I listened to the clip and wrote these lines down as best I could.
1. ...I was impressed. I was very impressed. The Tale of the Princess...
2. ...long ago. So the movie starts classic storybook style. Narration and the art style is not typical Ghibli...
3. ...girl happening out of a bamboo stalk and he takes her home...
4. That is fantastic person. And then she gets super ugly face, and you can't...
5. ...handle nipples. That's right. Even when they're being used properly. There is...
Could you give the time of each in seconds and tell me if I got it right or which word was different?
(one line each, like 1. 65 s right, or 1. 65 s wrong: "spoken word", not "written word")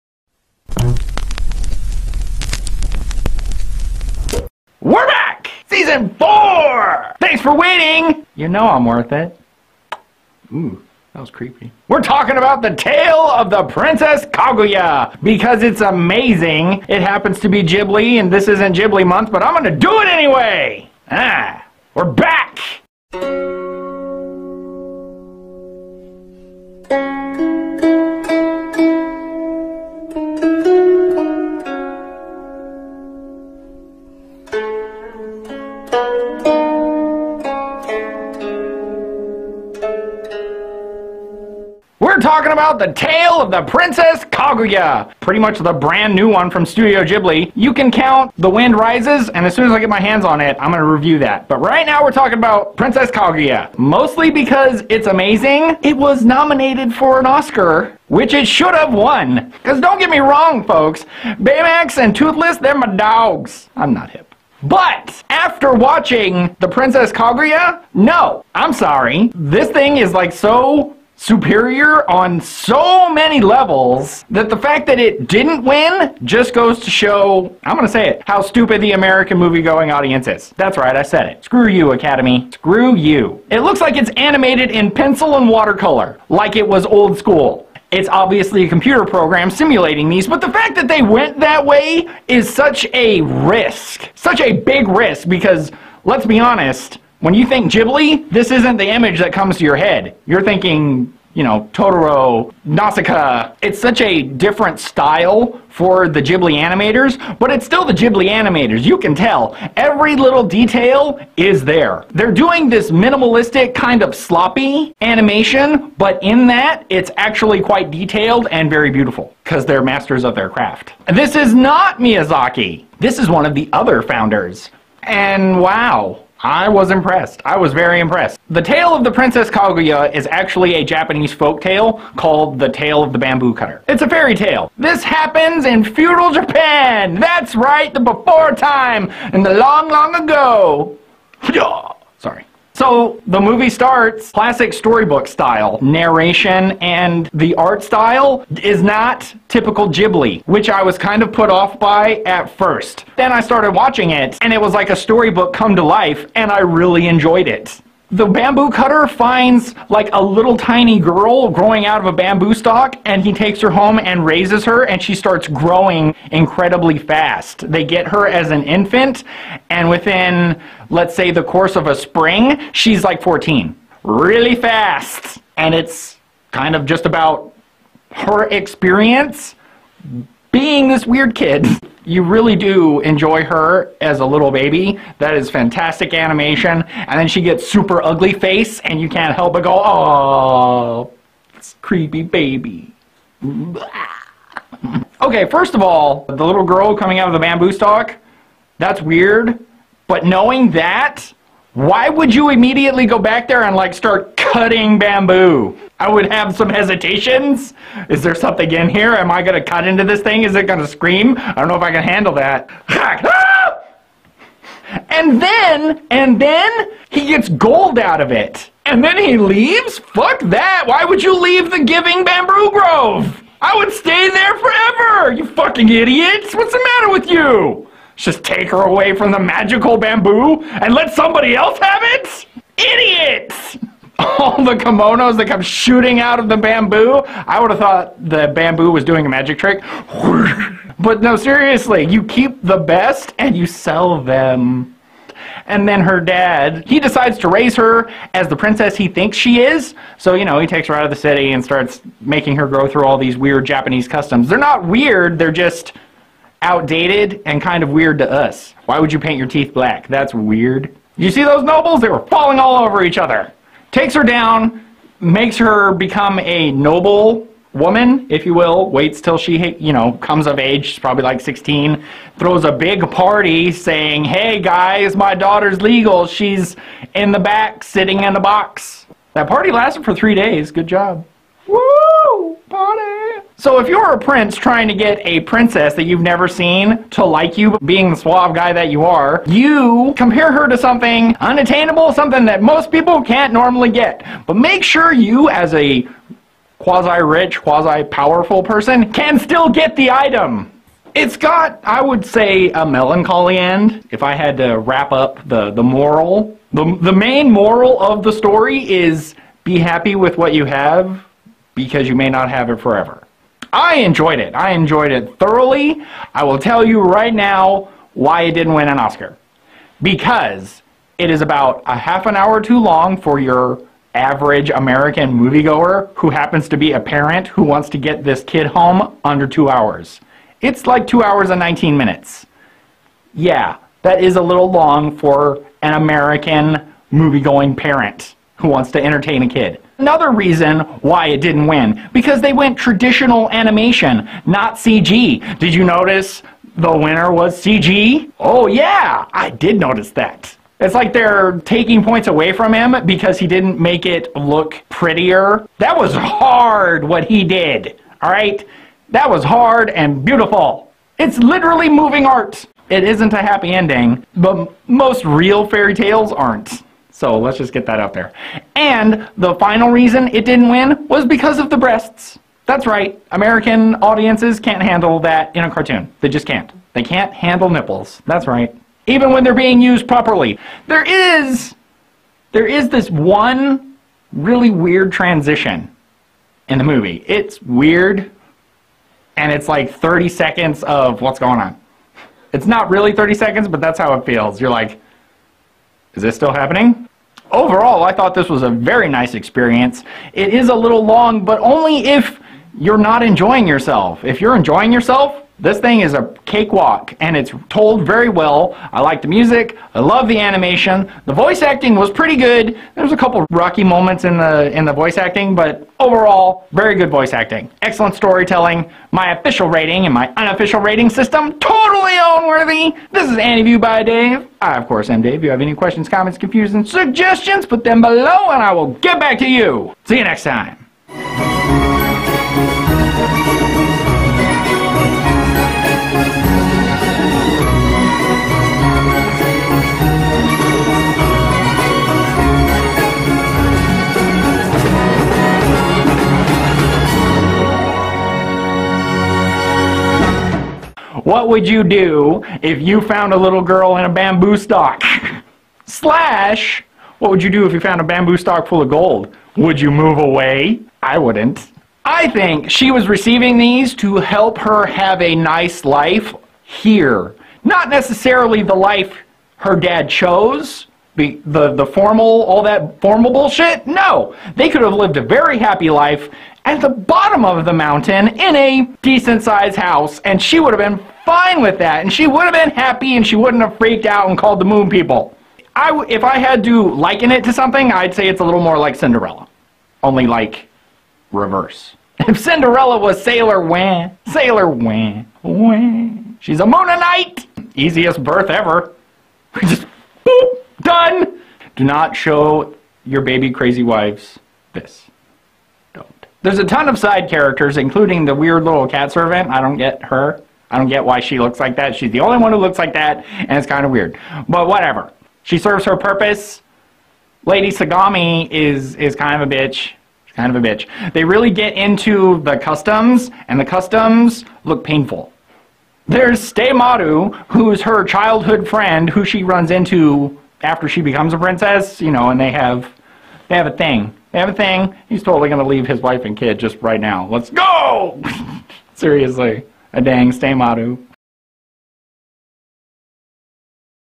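1. 126 s right
2. 139 s right
3. 160 s wrong: "growing", not "happening"
4. 185 s wrong: "animation", not "person"
5. 377 s right.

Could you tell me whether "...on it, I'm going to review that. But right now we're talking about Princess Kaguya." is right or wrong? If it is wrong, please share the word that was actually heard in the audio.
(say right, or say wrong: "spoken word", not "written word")
right.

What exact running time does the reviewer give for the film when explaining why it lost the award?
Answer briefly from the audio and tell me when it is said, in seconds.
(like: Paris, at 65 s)
2 hours and 19 minutes, at 331 s.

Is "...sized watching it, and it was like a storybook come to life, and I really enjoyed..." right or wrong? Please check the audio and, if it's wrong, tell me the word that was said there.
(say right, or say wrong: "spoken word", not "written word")
wrong: "started", not "sized".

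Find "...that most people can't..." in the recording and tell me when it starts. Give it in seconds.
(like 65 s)
292 s.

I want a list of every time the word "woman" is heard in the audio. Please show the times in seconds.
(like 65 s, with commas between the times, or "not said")
267 s.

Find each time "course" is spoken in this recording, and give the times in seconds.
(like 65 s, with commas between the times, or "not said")
171 s, 424 s.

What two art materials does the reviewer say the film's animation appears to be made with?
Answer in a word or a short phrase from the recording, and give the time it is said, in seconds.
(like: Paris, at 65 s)
Pencil and watercolor, at 84 s.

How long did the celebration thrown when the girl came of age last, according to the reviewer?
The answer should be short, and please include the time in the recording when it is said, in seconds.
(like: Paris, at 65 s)
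3 days, at 280 s.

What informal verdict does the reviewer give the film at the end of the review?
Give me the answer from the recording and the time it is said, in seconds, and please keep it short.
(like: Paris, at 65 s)
Totally own-worthy, at 421 s.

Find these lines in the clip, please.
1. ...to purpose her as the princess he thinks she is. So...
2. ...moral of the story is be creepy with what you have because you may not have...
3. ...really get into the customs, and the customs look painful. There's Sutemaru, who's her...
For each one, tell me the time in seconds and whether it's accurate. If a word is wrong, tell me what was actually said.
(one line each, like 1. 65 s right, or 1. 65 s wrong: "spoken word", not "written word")
1. 247 s wrong: "raise", not "purpose"
2. 307 s wrong: "happy", not "creepy"
3. 521 s right.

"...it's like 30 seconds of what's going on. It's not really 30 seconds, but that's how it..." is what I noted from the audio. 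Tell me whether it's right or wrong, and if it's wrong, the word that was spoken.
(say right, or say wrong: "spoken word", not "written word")
right.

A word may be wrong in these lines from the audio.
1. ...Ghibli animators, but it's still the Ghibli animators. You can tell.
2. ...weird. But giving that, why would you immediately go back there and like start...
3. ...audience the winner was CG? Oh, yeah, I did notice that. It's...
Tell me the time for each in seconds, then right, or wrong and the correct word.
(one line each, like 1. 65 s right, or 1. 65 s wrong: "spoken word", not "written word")
1. 106 s right
2. 199 s wrong: "knowing", not "giving"
3. 345 s wrong: "notice", not "audience".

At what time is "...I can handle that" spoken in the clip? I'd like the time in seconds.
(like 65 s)
211 s.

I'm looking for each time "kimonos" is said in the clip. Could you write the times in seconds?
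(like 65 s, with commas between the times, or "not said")
234 s.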